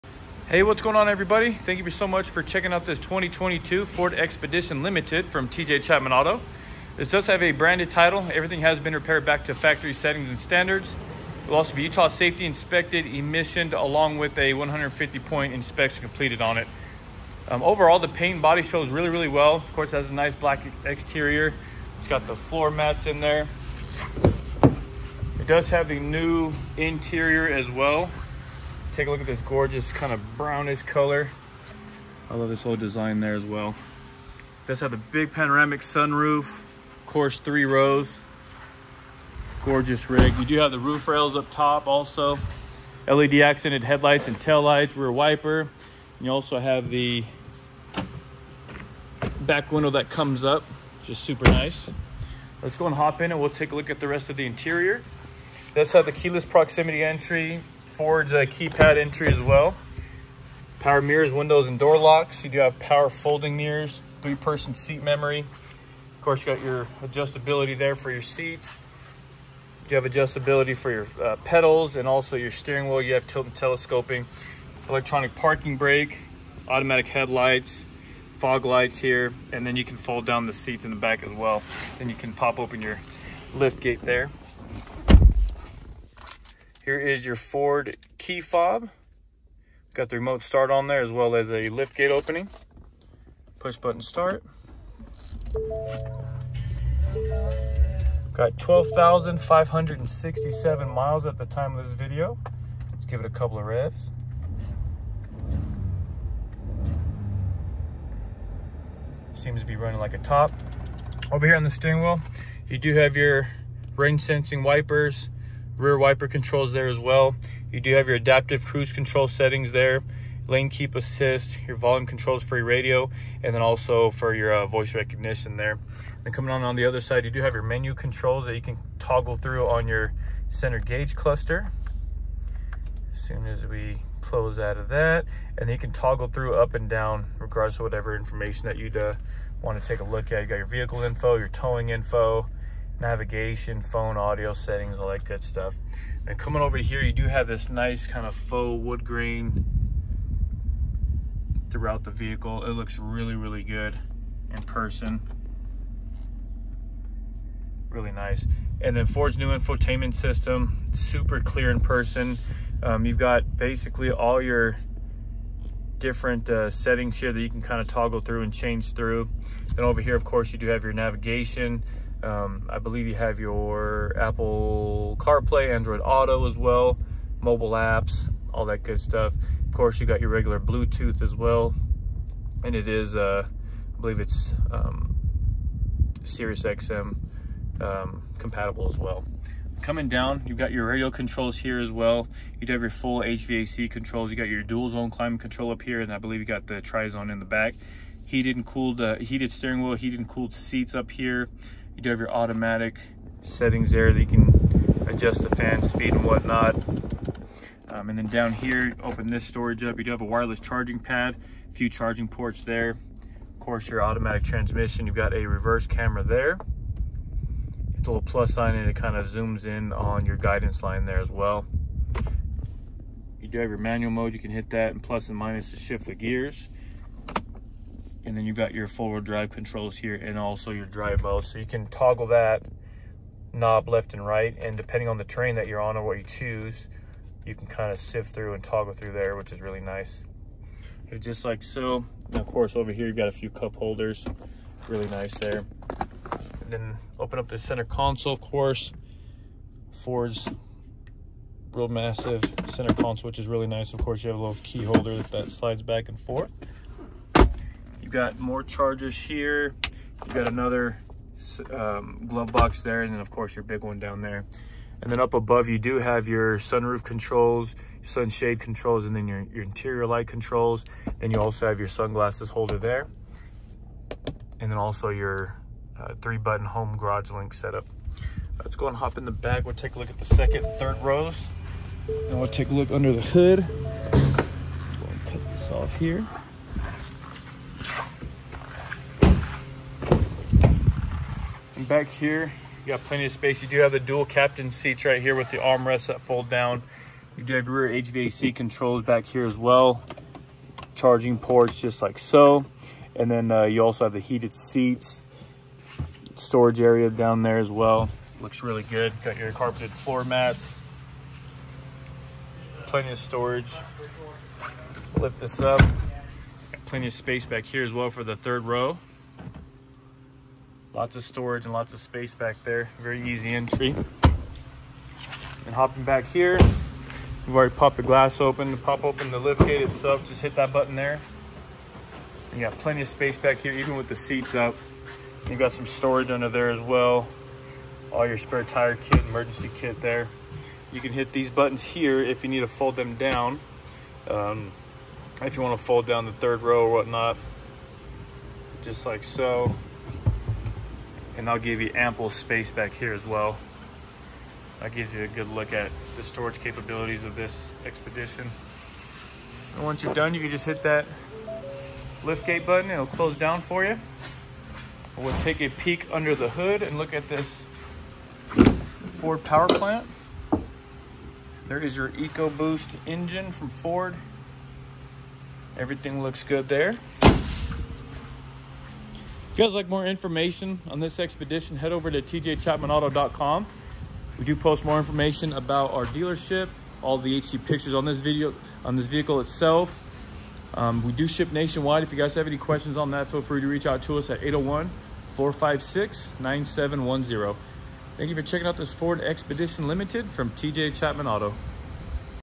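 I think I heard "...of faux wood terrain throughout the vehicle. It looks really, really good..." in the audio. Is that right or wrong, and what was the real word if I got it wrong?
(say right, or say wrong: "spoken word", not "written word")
wrong: "grain", not "terrain".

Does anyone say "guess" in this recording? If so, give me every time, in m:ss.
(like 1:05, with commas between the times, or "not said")
not said.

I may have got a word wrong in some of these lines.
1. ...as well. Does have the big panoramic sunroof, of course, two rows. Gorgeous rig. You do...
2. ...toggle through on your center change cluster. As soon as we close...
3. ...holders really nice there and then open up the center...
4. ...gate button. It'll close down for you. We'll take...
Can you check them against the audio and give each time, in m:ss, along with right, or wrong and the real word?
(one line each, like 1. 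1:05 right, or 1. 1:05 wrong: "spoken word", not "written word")
1. 0:33 wrong: "three", not "two"
2. 2:08 wrong: "gauge", not "change"
3. 4:03 right
4. 6:02 right.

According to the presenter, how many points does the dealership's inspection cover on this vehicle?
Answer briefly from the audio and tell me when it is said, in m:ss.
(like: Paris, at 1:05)
150, at 0:14.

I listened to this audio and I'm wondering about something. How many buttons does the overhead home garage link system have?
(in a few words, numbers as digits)
3.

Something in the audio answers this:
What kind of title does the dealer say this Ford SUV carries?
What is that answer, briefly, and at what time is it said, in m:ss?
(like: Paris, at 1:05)
Branded title, at 0:07.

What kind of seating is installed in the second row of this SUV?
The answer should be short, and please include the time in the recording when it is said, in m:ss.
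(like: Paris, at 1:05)
Dual captain seats, at 4:53.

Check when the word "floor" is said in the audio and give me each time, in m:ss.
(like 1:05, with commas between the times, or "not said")
0:22, 5:09.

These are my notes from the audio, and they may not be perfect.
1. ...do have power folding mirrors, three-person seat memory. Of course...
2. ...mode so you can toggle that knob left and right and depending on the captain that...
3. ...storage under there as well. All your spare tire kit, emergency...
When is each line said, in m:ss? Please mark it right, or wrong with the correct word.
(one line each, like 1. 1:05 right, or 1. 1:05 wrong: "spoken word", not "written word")
1. 1:02 right
2. 3:51 wrong: "terrain", not "captain"
3. 5:35 right.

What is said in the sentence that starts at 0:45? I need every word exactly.
And you also have the back window that comes up, just super nice.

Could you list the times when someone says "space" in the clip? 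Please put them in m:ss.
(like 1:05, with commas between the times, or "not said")
4:53, 5:17, 5:21, 5:33, 5:52.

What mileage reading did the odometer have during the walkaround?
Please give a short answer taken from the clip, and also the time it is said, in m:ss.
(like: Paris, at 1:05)
12,567, at 1:38.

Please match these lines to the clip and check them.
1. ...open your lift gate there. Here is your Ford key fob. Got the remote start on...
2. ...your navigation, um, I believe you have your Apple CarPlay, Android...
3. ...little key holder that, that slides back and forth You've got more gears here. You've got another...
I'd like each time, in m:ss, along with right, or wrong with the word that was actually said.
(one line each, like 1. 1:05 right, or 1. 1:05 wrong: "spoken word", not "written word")
1. 1:22 right
2. 2:50 right
3. 4:14 wrong: "chargers", not "gears".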